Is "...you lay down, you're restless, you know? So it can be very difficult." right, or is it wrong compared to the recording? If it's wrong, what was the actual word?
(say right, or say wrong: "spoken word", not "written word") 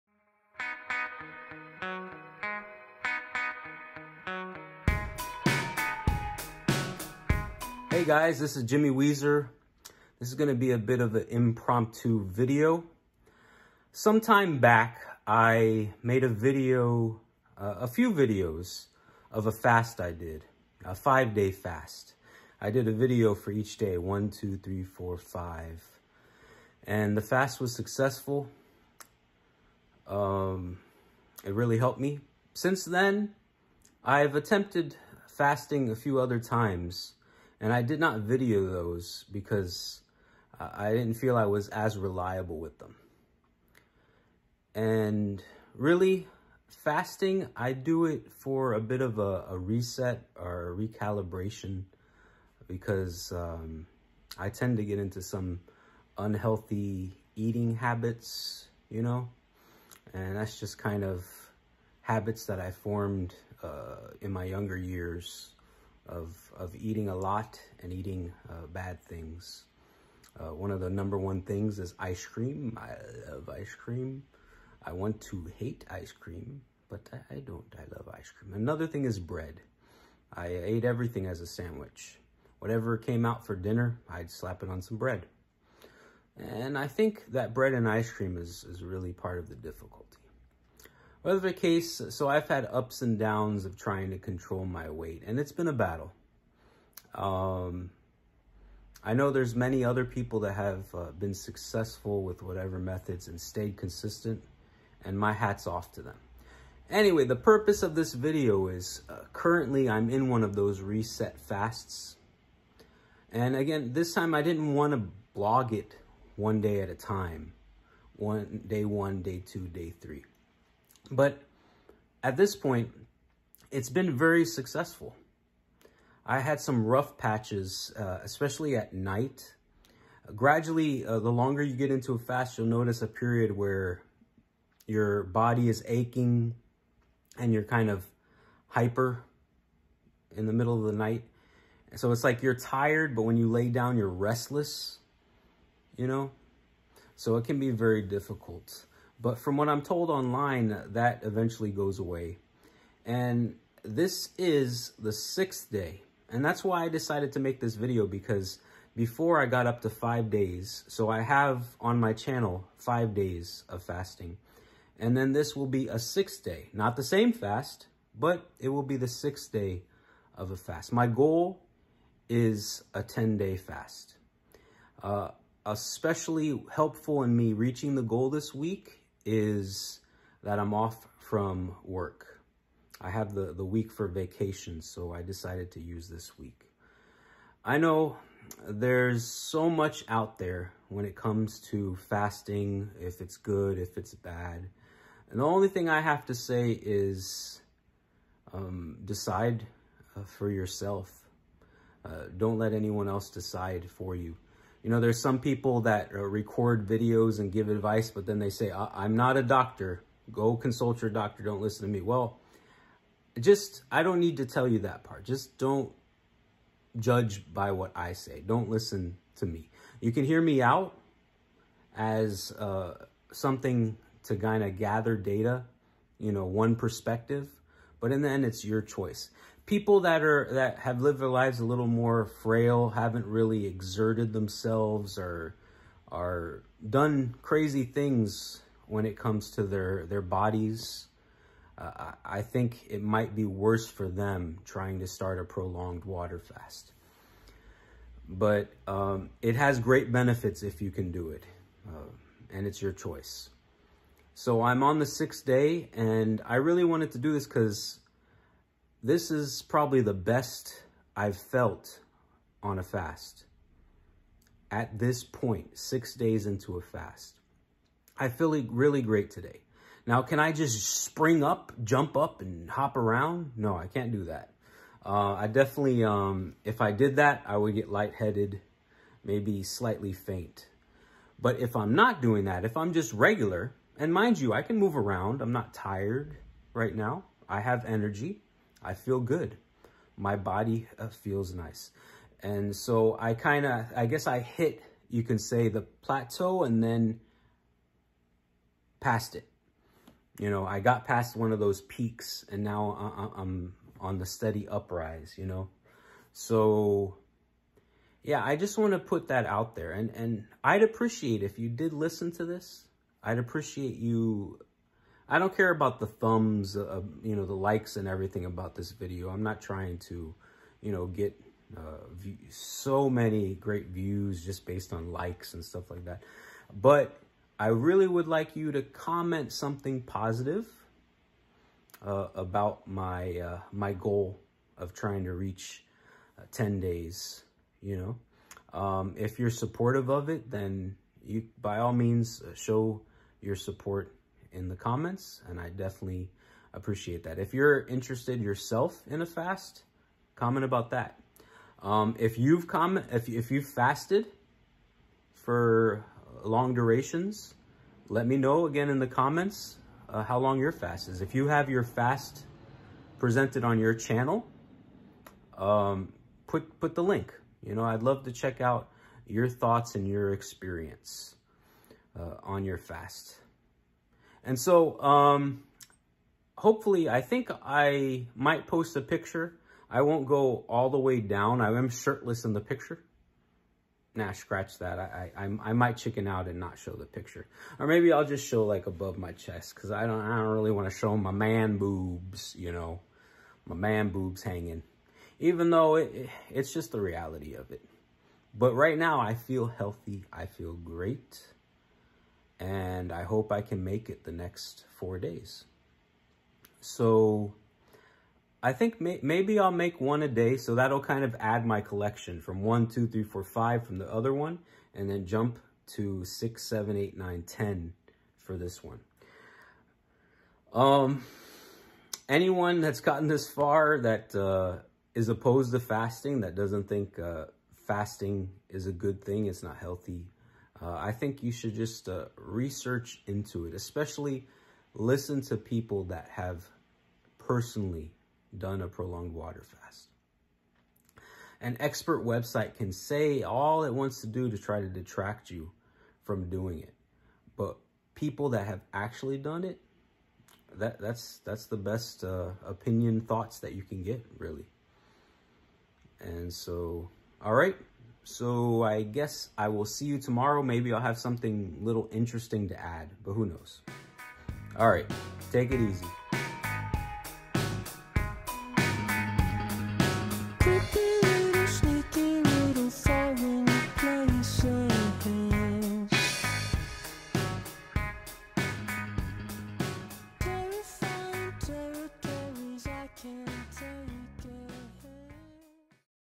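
right.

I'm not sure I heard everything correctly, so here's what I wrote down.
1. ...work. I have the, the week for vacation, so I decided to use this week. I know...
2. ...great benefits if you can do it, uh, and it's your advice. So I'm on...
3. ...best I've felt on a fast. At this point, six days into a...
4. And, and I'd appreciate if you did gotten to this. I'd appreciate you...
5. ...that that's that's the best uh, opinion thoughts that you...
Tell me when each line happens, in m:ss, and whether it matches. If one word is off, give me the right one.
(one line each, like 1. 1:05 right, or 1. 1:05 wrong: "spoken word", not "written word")
1. 3:01 right
2. 4:09 wrong: "choice", not "advice"
3. 4:20 right
4. 5:09 wrong: "listen", not "gotten"
5. 7:30 right.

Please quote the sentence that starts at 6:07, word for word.
You know, I'd love to check out your thoughts and your experience uh, on your fast.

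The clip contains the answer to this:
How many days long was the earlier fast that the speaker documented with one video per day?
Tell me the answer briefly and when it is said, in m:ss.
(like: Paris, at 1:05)
5, at 0:20.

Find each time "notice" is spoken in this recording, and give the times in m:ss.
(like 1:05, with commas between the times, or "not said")
2:12.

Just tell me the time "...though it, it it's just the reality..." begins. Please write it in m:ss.
6:35.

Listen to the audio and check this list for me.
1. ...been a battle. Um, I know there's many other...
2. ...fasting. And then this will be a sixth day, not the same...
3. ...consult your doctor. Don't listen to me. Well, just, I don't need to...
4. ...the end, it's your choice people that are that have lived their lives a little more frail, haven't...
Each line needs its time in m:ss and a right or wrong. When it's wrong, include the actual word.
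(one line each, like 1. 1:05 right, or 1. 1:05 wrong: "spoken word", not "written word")
1. 1:35 right
2. 2:43 right
3. 3:30 right
4. 3:48 right.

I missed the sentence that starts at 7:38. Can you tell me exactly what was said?
So I guess I will see you tomorrow.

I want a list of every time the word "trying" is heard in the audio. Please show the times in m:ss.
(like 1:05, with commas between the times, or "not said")
1:33, 4:04, 5:19, 5:34.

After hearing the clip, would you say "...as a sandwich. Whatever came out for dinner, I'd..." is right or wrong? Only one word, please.
right.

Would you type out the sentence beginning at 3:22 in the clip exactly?
Uh, don't let anyone else decide for you.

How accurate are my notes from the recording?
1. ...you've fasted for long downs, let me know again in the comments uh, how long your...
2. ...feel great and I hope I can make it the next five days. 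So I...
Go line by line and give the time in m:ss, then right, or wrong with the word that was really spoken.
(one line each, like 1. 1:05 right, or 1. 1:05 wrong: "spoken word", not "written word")
1. 5:53 wrong: "durations", not "downs"
2. 6:40 wrong: "four", not "five".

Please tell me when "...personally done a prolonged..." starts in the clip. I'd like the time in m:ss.
7:17.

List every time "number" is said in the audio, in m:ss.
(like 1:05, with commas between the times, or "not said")
1:10.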